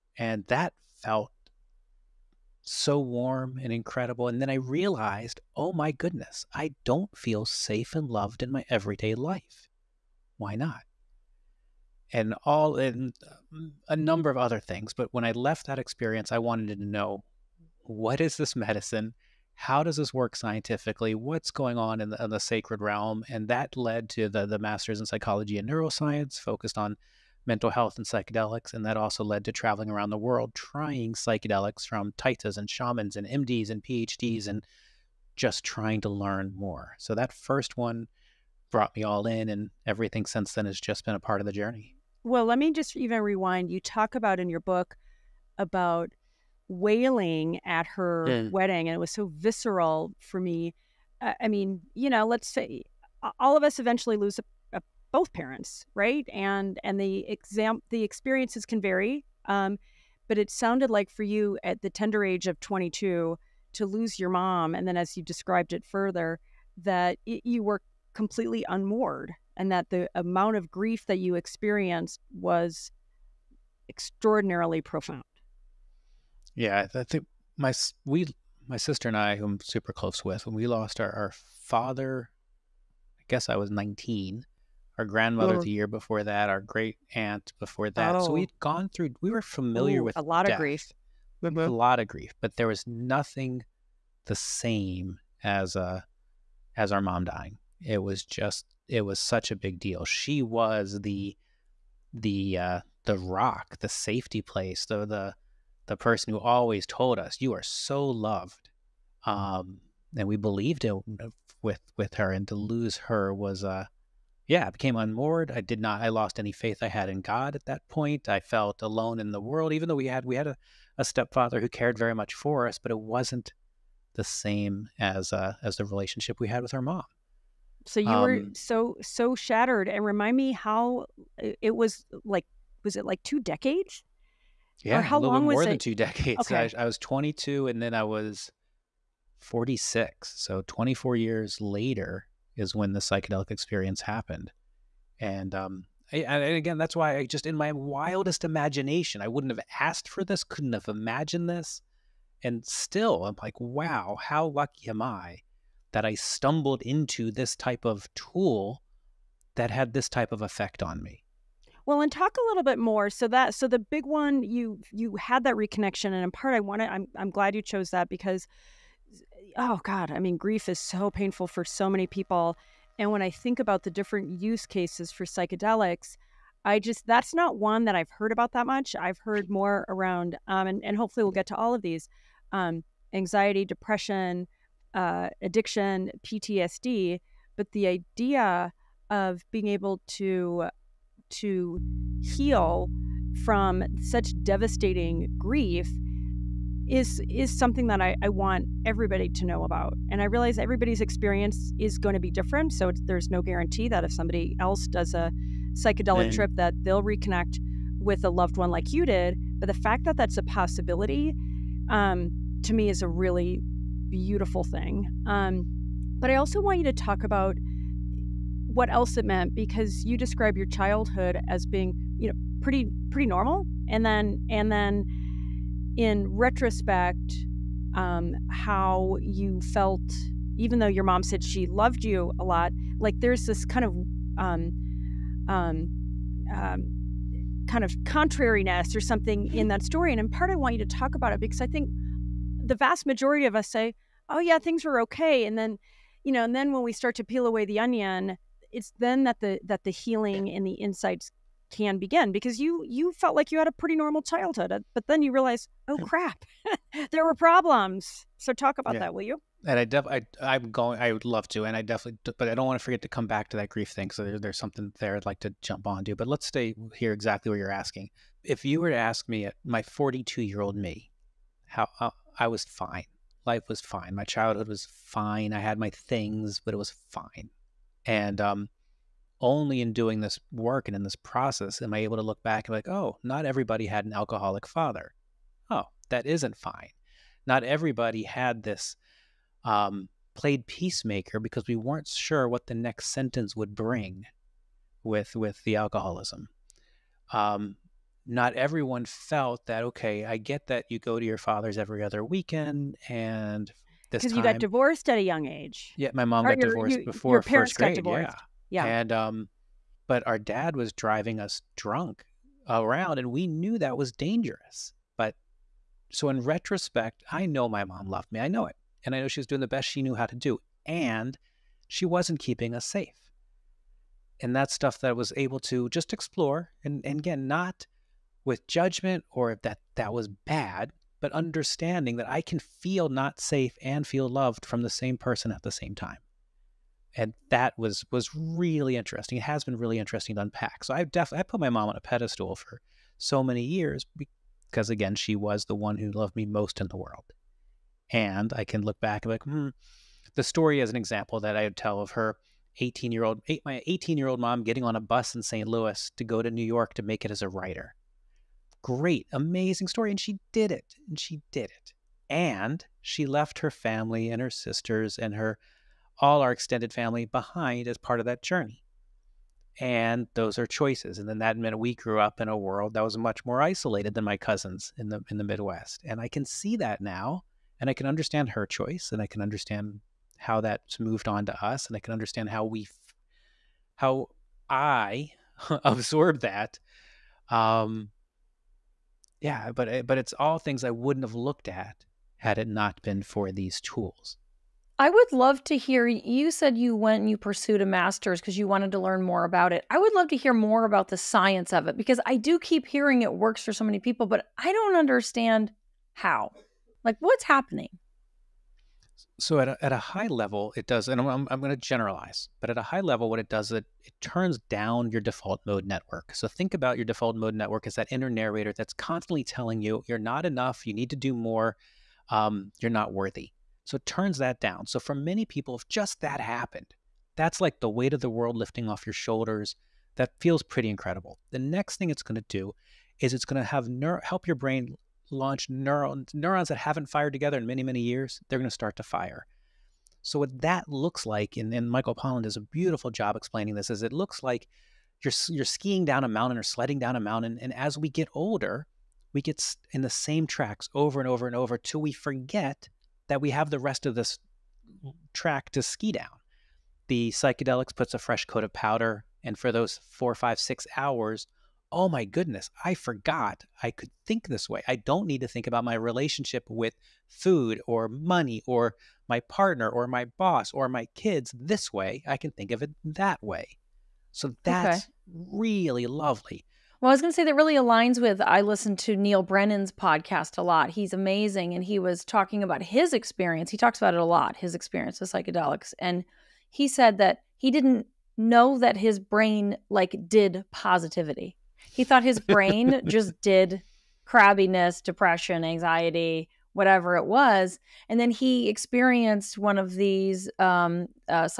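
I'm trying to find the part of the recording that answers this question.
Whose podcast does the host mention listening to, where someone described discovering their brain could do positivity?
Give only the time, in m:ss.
7:59.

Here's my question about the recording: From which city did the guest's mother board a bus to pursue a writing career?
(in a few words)
St. Louis.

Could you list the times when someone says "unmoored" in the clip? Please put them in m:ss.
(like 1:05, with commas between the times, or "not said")
1:08, 1:54.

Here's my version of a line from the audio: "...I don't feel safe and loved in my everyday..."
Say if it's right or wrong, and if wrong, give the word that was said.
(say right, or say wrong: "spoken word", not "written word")
right.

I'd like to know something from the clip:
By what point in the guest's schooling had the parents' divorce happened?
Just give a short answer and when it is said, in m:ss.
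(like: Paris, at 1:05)
Before first grade, at 5:07.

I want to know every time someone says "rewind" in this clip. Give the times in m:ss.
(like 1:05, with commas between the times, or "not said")
0:43.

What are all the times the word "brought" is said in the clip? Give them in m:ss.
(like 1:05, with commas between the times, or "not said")
0:38.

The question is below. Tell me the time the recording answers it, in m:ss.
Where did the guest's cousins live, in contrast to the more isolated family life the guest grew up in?
6:15.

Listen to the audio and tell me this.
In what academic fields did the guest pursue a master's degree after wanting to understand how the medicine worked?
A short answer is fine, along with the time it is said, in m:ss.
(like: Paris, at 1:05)
Psychology and neuroscience, at 0:25.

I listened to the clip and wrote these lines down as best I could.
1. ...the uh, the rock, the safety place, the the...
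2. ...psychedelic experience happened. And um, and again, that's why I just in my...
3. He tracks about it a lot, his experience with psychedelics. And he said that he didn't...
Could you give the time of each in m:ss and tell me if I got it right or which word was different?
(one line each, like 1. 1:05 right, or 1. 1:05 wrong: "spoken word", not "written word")
1. 1:42 right
2. 2:22 right
3. 8:03 wrong: "talks", not "tracks".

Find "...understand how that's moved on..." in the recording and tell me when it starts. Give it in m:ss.
6:19.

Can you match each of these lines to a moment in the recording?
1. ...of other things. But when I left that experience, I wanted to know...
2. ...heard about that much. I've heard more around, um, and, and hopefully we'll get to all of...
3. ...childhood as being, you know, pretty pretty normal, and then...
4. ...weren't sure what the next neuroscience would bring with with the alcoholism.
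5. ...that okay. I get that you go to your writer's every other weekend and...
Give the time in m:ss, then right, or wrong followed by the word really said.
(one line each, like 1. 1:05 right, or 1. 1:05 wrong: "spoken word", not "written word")
1. 0:14 right
2. 2:58 right
3. 3:40 right
4. 4:51 wrong: "sentence", not "neuroscience"
5. 4:59 wrong: "father", not "writer".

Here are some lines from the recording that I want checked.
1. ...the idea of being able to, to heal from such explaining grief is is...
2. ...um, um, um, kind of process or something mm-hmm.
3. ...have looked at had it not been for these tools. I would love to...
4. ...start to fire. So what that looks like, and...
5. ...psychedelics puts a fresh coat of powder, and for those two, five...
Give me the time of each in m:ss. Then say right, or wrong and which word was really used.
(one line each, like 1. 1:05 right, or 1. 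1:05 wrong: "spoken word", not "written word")
1. 3:07 wrong: "devastating", not "explaining"
2. 3:54 wrong: "contrariness", not "process"
3. 6:31 right
4. 7:18 right
5. 7:37 wrong: "four", not "two".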